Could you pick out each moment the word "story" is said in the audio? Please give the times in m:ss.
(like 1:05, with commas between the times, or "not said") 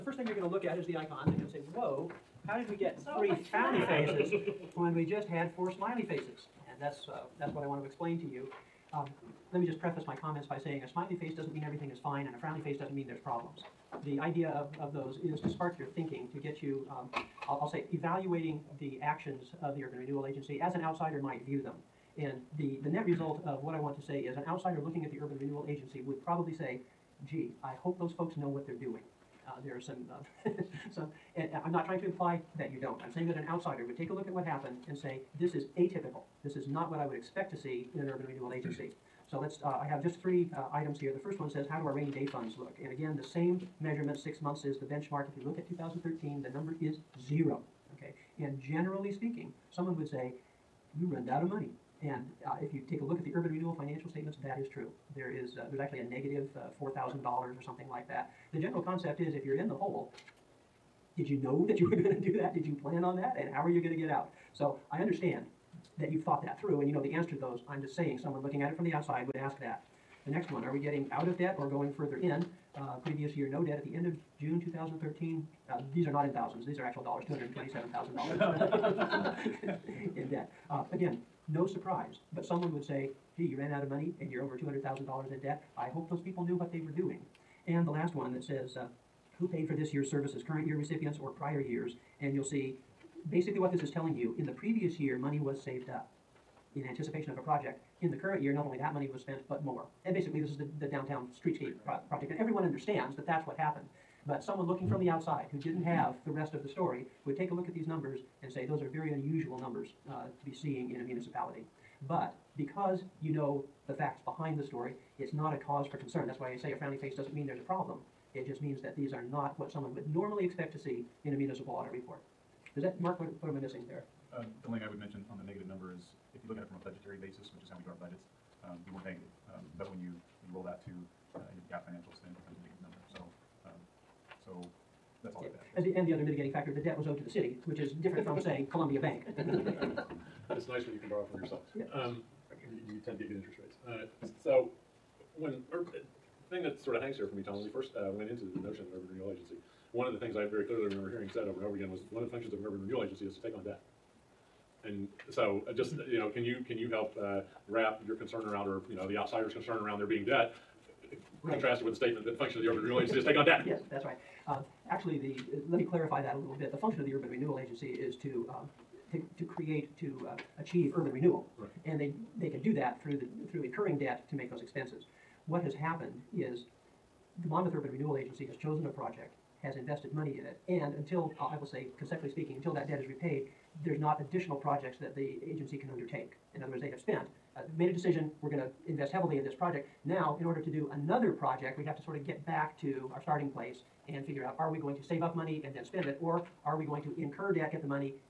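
1:46, 1:54.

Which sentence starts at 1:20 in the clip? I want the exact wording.
Uh, again, no surprise, but someone would say, gee, you ran out of money and you're over $200,000 in debt.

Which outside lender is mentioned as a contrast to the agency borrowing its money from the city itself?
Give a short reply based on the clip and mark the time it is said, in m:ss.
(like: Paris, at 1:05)
Columbia Bank, at 2:18.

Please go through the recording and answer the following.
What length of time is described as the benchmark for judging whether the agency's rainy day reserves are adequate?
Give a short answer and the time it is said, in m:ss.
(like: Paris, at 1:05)
6 months, at 0:44.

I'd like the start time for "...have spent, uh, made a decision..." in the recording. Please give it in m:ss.
3:06.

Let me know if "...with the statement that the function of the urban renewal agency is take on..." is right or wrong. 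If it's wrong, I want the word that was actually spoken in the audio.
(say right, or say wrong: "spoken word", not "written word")
right.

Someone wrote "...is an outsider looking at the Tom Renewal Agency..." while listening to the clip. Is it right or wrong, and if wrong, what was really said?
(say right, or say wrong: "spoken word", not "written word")
wrong: "Urban", not "Tom".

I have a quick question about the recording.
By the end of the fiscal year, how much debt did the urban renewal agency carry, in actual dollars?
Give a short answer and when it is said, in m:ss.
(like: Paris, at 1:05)
$227,000, at 1:17.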